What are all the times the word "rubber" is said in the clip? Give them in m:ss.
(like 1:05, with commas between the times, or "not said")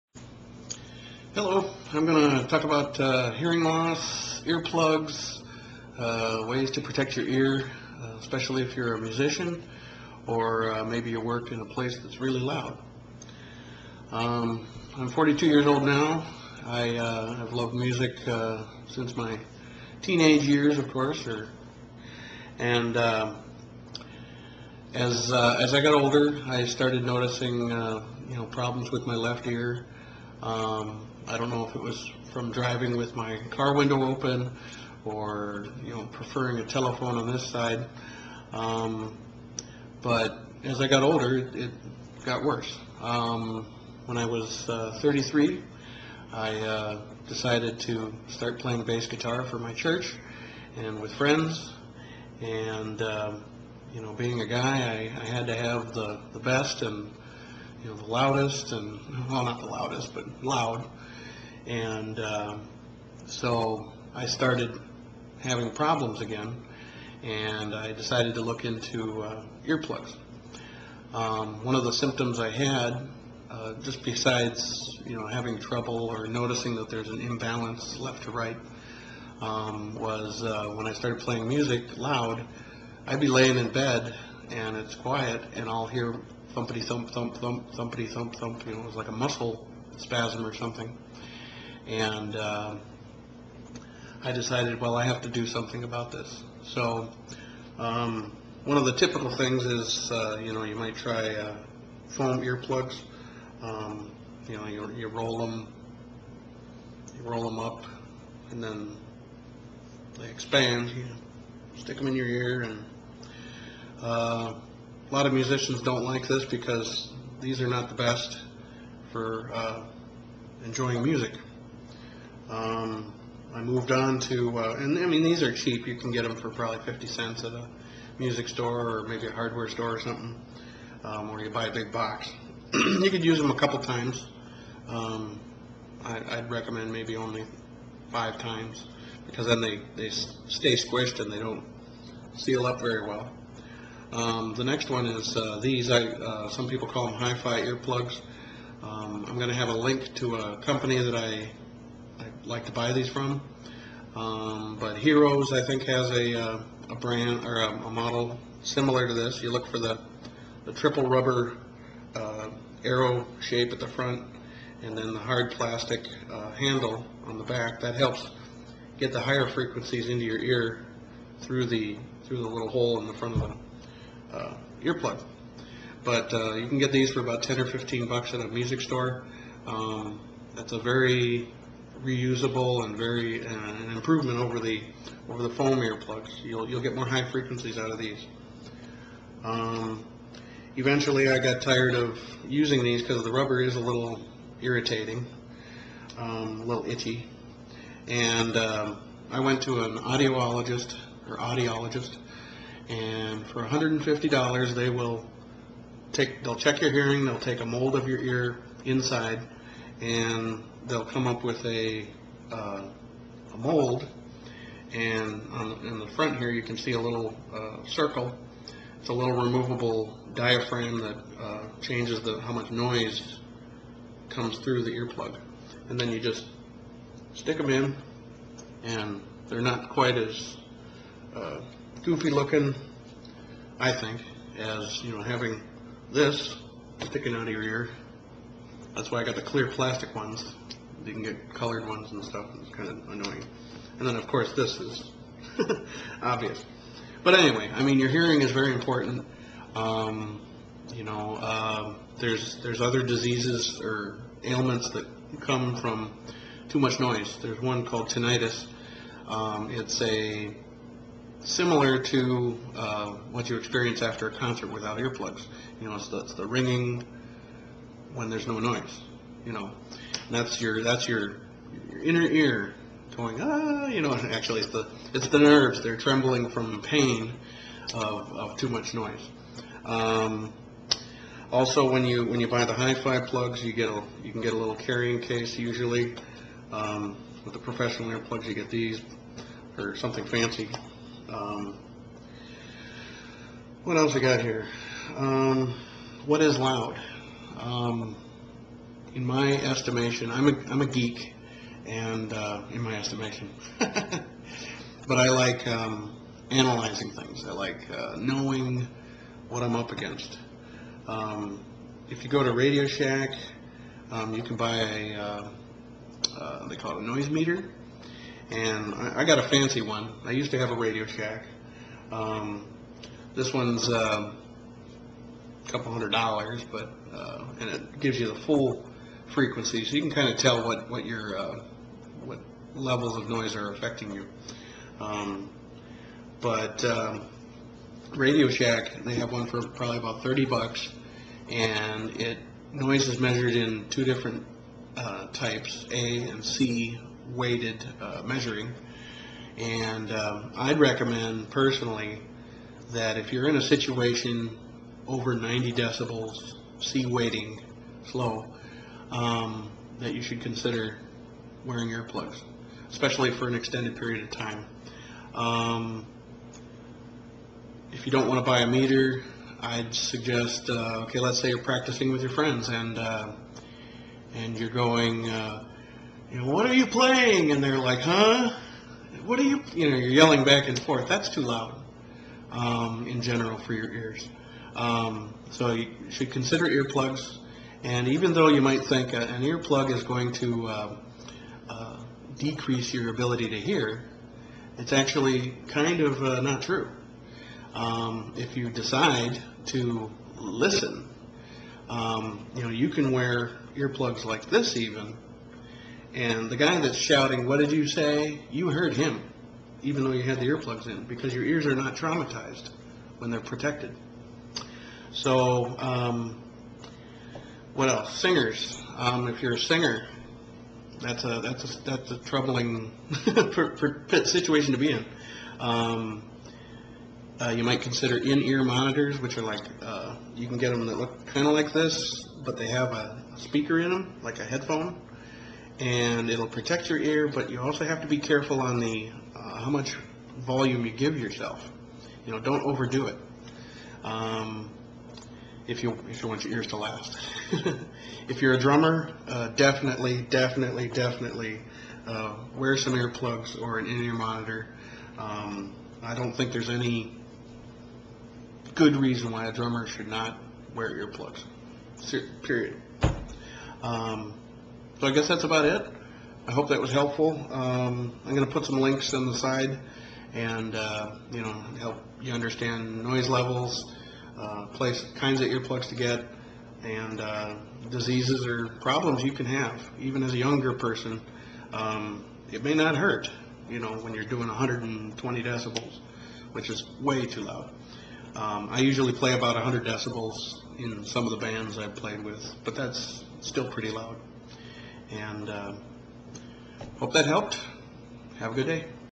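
2:41, 3:13.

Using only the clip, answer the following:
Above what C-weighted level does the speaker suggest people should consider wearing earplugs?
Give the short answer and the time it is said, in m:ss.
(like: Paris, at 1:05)
90 decibels, at 5:55.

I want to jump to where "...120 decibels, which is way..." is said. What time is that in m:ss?
8:04.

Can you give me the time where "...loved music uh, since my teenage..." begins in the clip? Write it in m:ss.
0:17.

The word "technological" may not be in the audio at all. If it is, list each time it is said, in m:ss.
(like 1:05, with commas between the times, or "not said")
not said.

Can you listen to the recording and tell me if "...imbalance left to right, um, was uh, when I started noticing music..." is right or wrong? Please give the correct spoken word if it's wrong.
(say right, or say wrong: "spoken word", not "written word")
wrong: "playing", not "noticing".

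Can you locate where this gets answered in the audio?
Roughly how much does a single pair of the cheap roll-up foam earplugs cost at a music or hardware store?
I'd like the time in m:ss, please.
2:06.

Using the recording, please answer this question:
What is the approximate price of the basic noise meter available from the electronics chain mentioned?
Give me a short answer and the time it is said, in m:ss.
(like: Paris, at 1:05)
$30, at 5:40.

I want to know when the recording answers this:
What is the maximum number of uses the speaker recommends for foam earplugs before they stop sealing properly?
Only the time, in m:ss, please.
2:18.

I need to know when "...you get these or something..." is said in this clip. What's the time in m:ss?
4:48.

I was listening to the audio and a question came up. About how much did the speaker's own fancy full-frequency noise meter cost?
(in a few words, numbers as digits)
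A couple hundred dollars.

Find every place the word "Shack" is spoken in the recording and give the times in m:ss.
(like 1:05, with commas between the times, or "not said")
5:12, 5:21, 5:38.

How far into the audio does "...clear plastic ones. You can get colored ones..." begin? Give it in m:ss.
3:59.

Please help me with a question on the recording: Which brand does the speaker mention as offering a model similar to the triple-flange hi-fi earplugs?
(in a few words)
Hearos.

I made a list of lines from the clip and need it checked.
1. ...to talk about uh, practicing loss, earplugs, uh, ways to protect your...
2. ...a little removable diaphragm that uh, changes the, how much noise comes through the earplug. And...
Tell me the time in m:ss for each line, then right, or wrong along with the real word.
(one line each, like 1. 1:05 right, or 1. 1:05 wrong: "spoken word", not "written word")
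1. 0:02 wrong: "hearing", not "practicing"
2. 3:39 right.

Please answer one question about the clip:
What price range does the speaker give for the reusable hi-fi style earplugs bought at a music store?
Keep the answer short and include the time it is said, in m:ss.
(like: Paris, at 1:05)
$10 or $15, at 2:57.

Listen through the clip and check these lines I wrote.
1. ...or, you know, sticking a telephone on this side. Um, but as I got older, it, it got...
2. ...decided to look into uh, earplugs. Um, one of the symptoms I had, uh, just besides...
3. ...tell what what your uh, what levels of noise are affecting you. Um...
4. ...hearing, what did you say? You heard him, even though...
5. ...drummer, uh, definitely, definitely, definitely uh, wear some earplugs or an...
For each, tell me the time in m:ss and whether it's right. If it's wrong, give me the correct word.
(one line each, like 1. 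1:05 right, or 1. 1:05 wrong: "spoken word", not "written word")
1. 0:35 wrong: "preferring", not "sticking"
2. 1:07 right
3. 5:30 right
4. 6:46 wrong: "shouting", not "hearing"
5. 7:28 right.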